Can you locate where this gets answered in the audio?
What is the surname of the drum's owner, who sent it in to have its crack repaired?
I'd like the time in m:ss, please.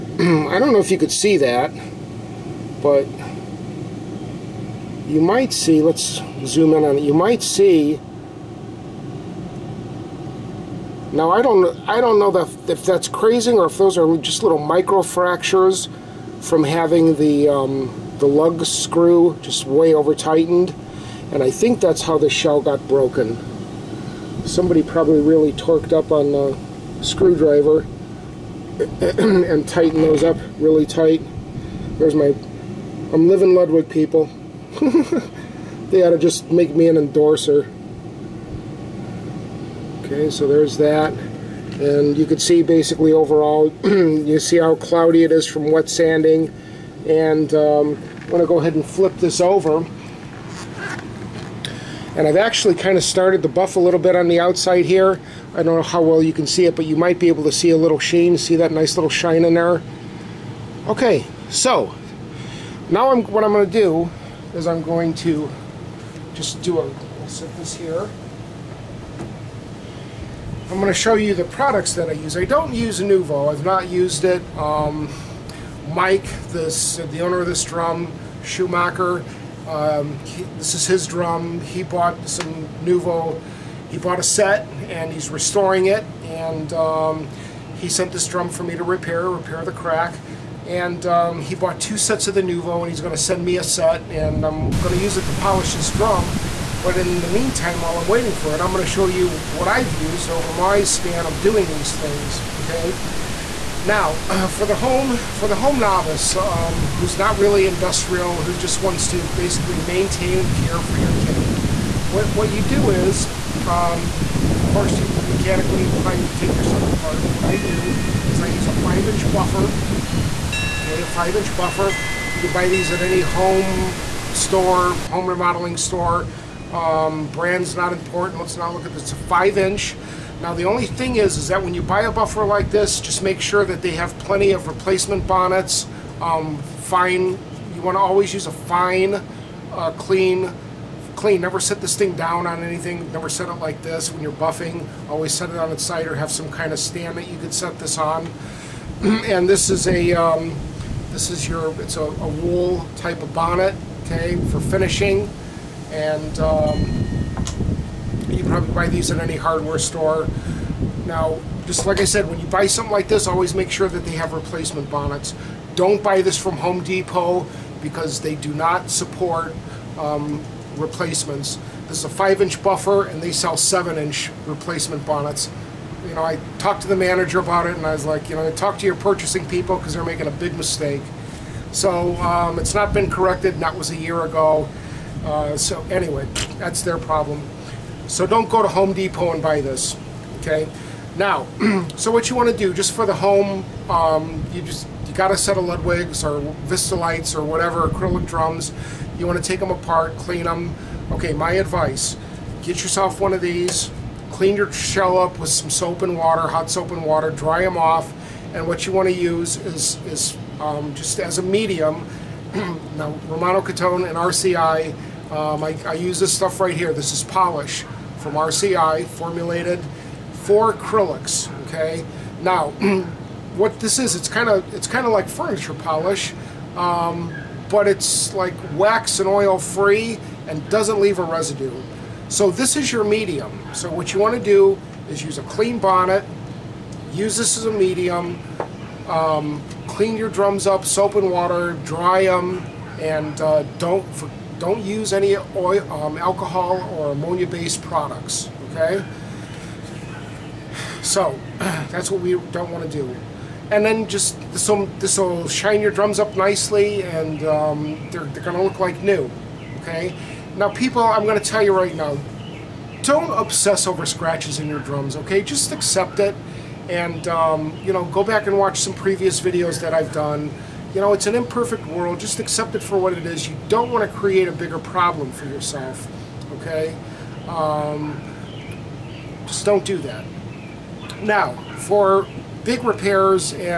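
1:18.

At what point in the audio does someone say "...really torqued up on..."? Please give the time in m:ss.
0:25.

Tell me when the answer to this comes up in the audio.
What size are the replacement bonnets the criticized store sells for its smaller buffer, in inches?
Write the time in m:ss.
2:53.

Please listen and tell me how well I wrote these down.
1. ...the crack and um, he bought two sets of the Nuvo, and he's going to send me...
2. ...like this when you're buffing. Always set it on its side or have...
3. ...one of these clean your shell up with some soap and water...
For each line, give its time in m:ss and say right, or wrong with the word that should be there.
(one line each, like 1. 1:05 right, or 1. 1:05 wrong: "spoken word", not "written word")
1. 1:29 right
2. 2:23 right
3. 3:23 right.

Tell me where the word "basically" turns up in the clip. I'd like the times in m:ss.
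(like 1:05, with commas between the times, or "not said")
0:42, 1:49.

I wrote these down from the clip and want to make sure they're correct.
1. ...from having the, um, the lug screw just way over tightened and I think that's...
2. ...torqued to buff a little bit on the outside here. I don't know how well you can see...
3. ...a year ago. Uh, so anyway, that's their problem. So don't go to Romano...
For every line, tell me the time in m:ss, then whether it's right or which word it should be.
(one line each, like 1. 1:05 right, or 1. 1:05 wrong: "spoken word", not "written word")
1. 0:16 right
2. 0:53 wrong: "started", not "torqued"
3. 3:03 wrong: "Home", not "Romano".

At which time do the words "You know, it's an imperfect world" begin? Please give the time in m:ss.
4:30.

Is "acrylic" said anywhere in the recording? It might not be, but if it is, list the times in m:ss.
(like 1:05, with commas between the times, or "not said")
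3:17, 3:40.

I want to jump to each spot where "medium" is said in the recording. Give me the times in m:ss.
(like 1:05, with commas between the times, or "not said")
3:31, 3:53, 3:57.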